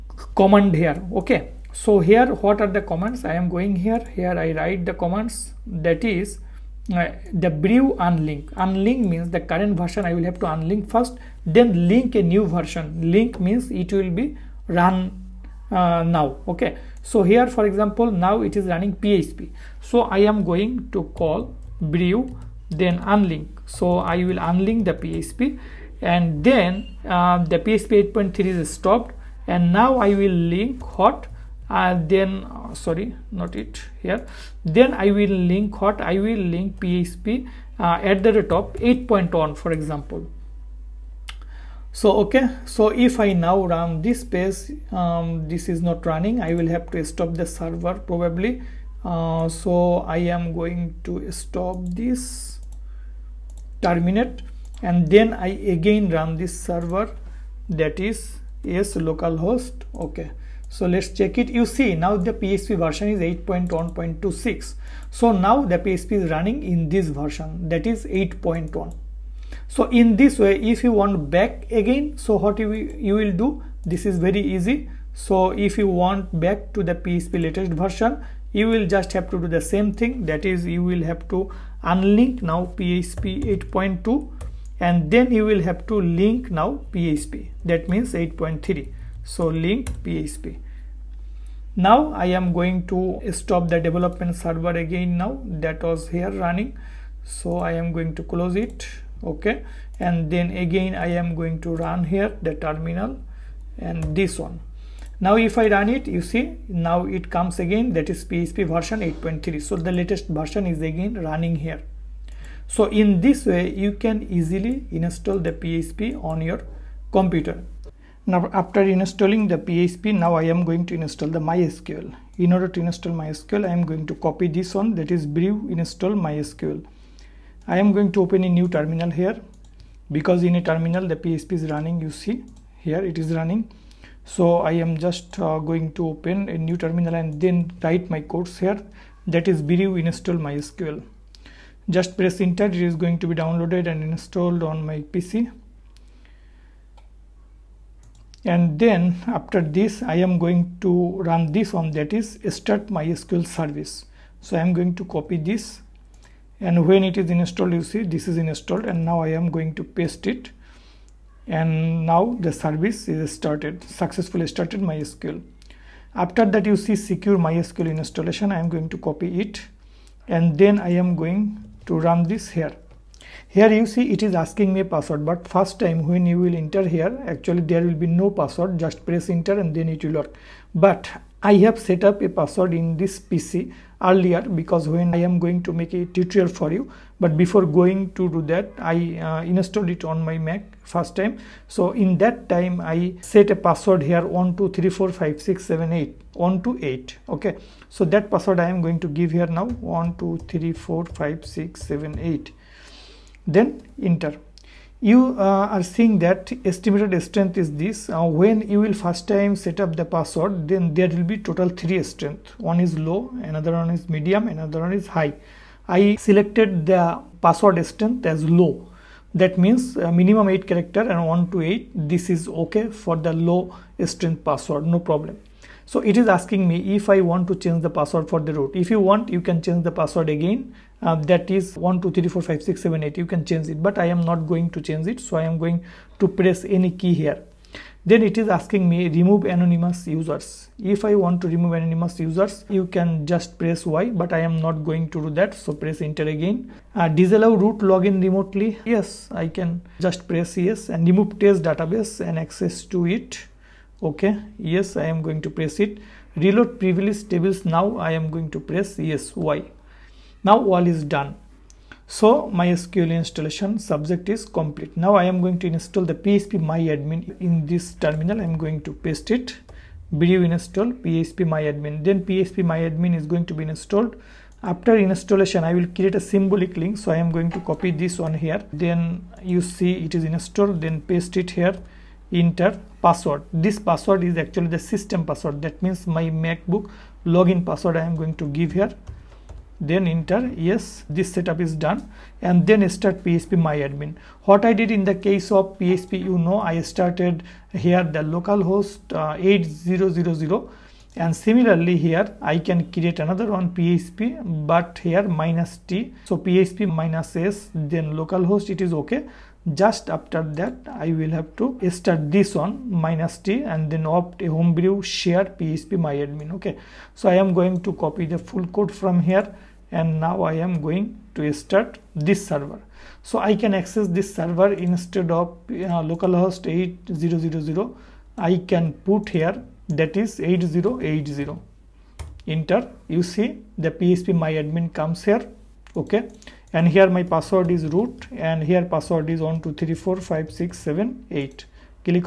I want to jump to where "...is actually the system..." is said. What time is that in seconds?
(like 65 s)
284 s.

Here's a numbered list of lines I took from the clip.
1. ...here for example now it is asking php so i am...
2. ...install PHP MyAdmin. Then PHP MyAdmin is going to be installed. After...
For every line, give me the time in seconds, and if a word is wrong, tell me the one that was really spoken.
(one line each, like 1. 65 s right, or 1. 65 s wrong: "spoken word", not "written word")
1. 17 s wrong: "running", not "asking"
2. 270 s right.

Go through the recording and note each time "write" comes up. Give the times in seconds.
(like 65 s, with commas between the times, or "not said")
4 s, 137 s.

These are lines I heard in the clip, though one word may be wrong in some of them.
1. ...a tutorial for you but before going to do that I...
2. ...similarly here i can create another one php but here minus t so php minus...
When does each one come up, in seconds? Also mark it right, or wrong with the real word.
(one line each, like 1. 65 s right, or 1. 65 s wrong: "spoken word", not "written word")
1. 185 s right
2. 301 s right.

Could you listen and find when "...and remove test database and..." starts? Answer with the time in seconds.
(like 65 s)
250 s.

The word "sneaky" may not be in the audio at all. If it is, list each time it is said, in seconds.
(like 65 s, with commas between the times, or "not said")
not said.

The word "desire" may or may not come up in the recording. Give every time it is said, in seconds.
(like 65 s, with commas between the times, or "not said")
not said.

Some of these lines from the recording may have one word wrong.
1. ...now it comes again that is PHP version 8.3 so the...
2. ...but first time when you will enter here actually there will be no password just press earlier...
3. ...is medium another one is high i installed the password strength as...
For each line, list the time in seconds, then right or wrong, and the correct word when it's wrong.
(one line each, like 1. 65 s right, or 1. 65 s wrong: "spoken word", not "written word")
1. 106 s right
2. 175 s wrong: "enter", not "earlier"
3. 213 s wrong: "selected", not "installed".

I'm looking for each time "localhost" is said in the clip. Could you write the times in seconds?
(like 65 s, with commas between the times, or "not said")
58 s, 298 s, 308 s, 326 s.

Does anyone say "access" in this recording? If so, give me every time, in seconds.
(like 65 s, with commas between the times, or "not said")
252 s, 323 s.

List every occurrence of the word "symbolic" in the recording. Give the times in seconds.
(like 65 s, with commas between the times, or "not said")
276 s.